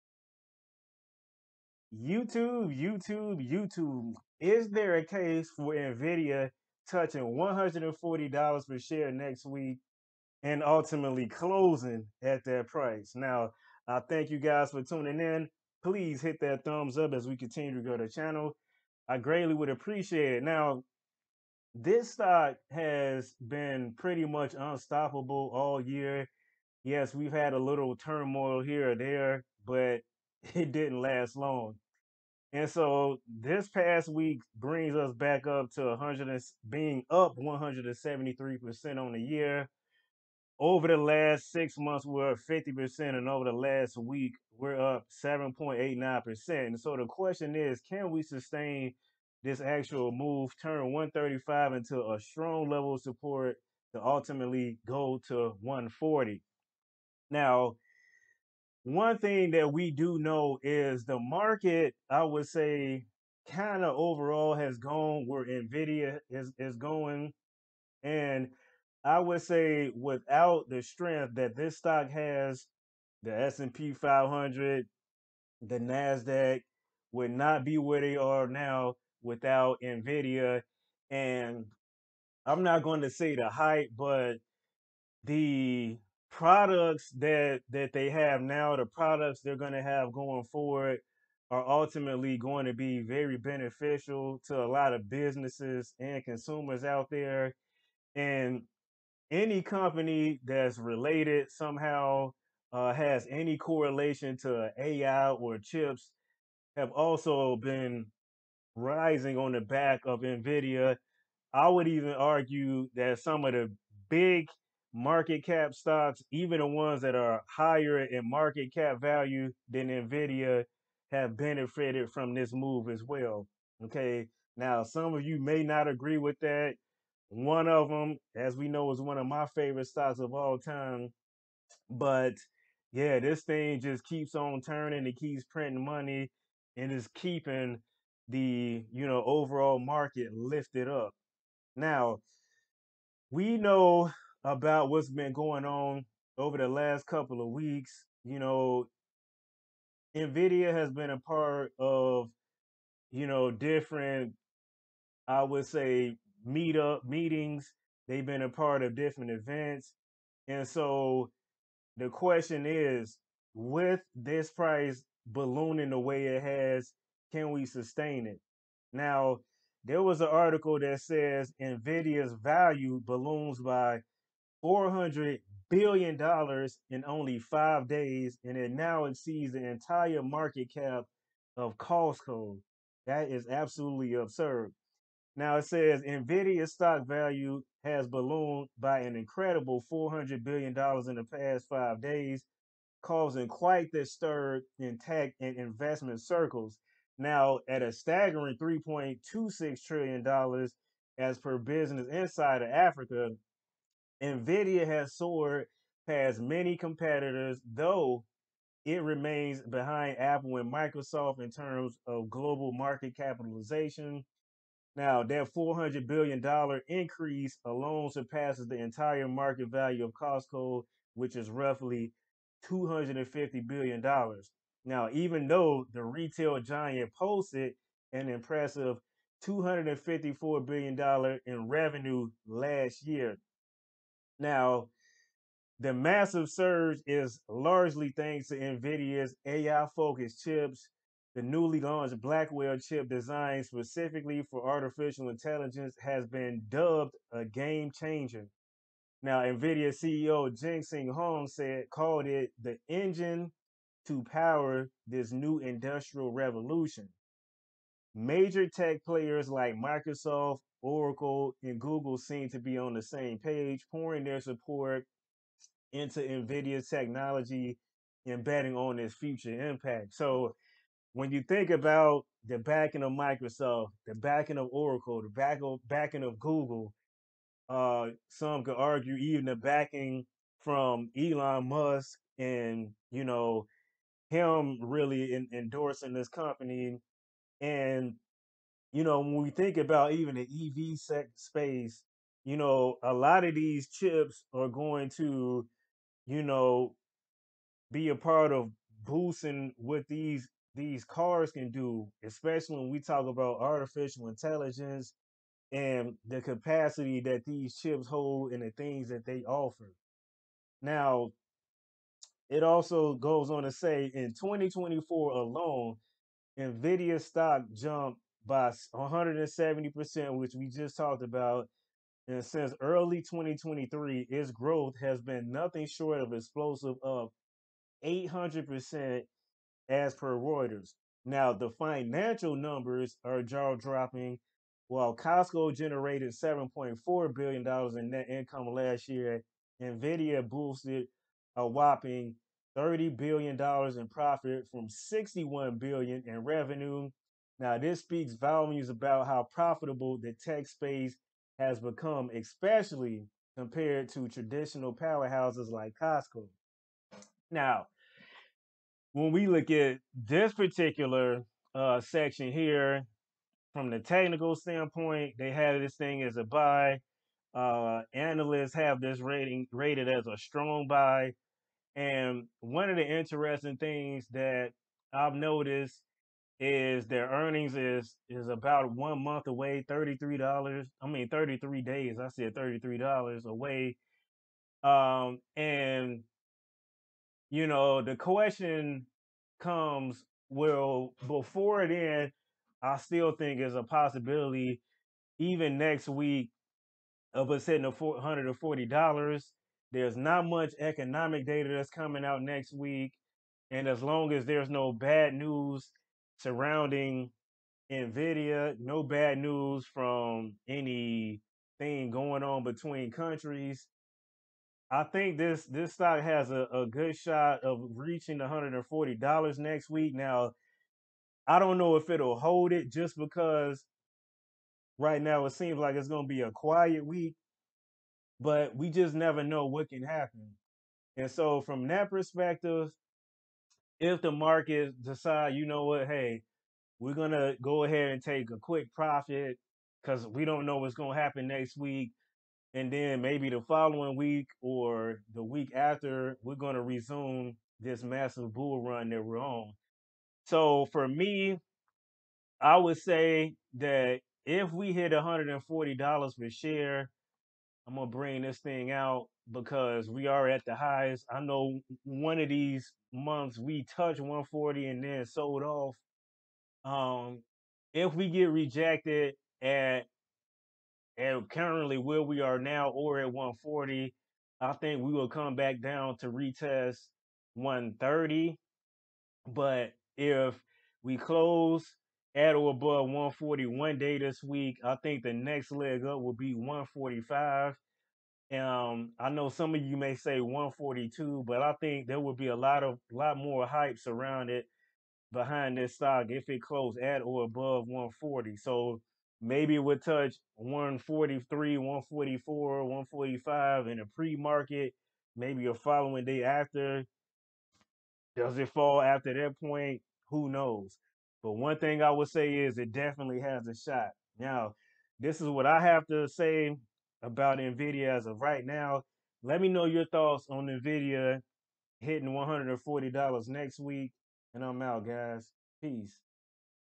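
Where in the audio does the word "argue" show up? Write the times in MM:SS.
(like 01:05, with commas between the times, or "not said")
01:52, 04:38.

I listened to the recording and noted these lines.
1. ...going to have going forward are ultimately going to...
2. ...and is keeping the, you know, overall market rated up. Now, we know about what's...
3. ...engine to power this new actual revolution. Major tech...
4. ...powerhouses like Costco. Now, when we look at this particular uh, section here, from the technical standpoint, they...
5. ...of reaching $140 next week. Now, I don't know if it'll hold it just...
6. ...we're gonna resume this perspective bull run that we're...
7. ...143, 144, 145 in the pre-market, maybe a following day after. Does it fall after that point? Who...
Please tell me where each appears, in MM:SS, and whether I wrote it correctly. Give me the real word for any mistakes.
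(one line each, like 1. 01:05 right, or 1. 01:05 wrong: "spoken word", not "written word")
1. 01:29 right
2. 02:16 wrong: "lifted", not "rated"
3. 04:12 wrong: "industrial", not "actual"
4. 05:54 right
5. 06:57 right
6. 07:26 wrong: "massive", not "perspective"
7. 08:20 right.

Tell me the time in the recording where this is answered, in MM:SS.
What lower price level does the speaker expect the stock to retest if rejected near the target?
07:57.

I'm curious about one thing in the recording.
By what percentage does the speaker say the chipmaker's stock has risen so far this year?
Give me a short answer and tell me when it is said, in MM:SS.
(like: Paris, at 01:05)
173%, at 00:37.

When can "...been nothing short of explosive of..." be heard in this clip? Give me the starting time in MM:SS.
05:25.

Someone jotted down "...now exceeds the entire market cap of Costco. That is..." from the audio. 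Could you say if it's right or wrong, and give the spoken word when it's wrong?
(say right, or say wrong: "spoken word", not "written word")
right.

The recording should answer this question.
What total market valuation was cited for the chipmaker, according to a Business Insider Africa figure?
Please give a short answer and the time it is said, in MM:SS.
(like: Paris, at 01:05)
$3.26 trillion, at 03:18.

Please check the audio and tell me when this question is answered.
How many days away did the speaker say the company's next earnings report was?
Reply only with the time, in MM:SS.
06:21.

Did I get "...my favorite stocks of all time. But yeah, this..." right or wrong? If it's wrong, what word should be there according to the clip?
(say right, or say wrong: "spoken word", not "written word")
right.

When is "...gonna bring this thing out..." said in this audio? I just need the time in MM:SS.
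07:37.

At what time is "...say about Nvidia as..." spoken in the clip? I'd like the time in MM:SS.
08:36.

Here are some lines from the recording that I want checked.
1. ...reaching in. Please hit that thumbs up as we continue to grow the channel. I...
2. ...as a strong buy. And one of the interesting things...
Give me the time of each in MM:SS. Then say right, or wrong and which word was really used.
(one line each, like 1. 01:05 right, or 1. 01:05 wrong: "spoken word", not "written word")
1. 00:14 wrong: "tuning", not "reaching"
2. 06:10 right.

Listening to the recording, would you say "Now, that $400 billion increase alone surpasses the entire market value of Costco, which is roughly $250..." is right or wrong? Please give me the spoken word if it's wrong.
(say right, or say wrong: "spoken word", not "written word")
right.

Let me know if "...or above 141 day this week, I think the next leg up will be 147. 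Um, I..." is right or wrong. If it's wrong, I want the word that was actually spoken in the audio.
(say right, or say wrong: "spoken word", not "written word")
wrong: "145", not "147".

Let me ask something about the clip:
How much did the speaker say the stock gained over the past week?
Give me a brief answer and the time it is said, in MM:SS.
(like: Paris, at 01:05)
7.89%, at 00:45.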